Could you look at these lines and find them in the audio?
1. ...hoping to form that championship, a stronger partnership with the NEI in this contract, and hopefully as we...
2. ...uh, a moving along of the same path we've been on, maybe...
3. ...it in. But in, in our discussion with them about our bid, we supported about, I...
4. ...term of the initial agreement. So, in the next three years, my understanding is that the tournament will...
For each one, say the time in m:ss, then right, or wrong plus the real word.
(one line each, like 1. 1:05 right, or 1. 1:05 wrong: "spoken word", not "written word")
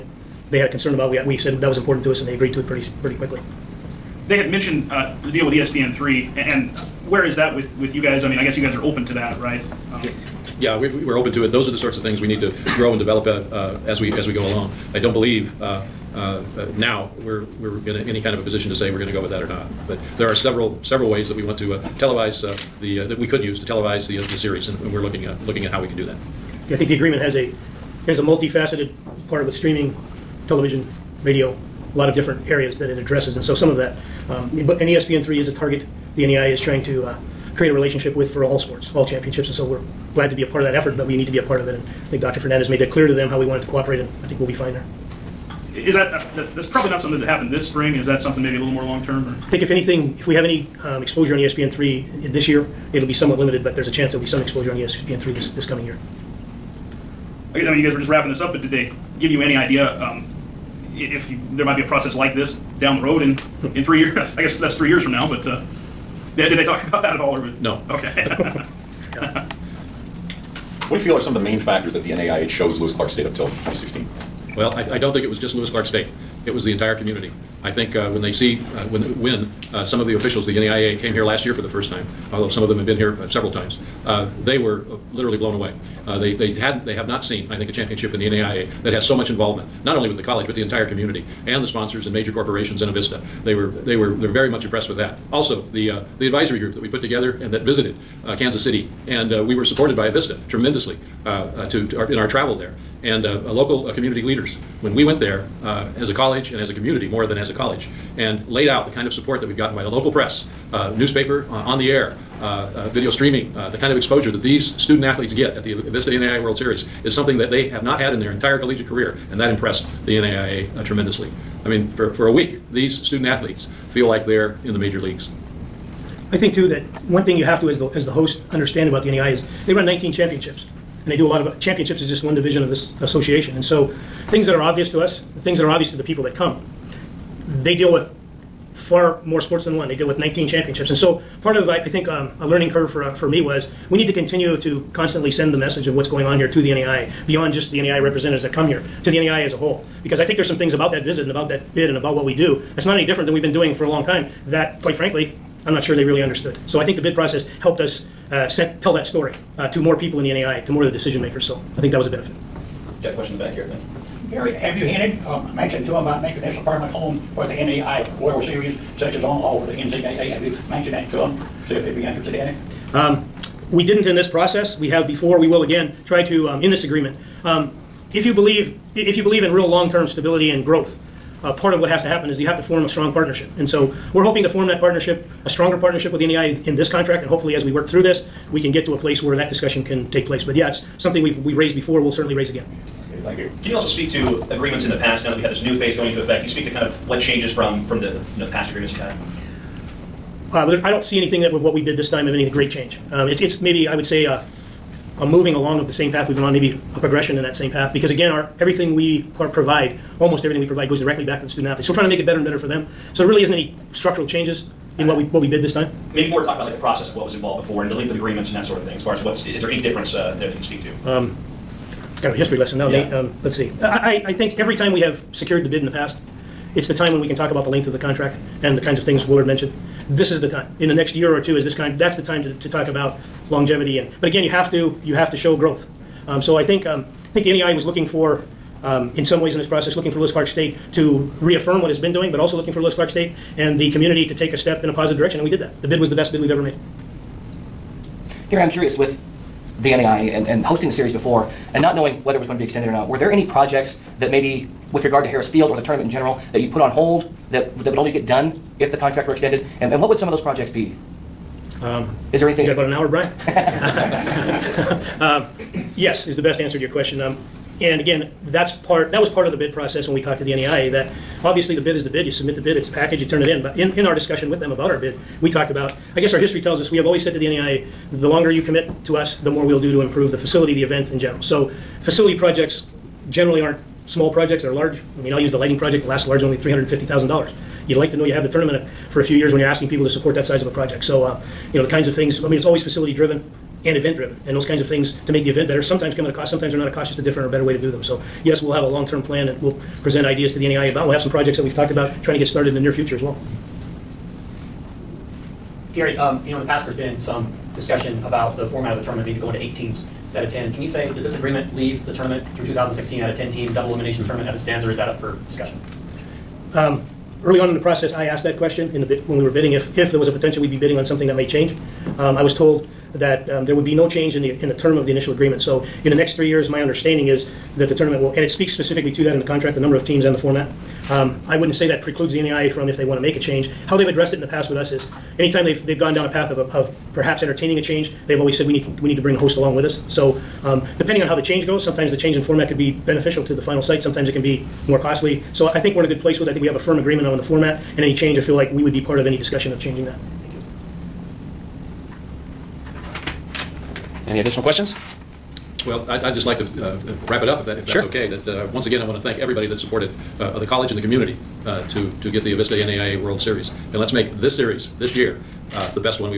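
1. 3:04 wrong: "partnership", not "championship"
2. 3:24 right
3. 4:33 wrong: "talked", not "supported"
4. 5:24 right.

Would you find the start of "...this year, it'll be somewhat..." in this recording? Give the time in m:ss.
0:52.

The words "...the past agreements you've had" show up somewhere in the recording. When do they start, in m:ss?
3:18.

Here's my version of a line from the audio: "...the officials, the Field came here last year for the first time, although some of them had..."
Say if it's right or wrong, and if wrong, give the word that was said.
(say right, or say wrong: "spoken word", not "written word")
wrong: "NAIA", not "Field".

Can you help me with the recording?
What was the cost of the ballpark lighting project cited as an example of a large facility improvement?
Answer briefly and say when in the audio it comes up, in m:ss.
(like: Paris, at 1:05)
$350,000, at 4:46.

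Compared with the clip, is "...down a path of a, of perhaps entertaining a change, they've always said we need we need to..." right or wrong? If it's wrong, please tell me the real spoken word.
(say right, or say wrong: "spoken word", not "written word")
right.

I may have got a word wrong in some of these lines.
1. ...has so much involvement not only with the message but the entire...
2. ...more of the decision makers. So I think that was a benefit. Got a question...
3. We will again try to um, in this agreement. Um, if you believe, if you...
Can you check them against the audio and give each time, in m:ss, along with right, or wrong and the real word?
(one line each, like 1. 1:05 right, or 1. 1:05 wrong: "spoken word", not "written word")
1. 1:28 wrong: "college", not "message"
2. 2:40 right
3. 2:55 right.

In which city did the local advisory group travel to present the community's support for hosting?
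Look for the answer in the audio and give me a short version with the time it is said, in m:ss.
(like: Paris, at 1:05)
Kansas City, at 1:38.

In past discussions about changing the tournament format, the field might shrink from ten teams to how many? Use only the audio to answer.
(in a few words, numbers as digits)
8.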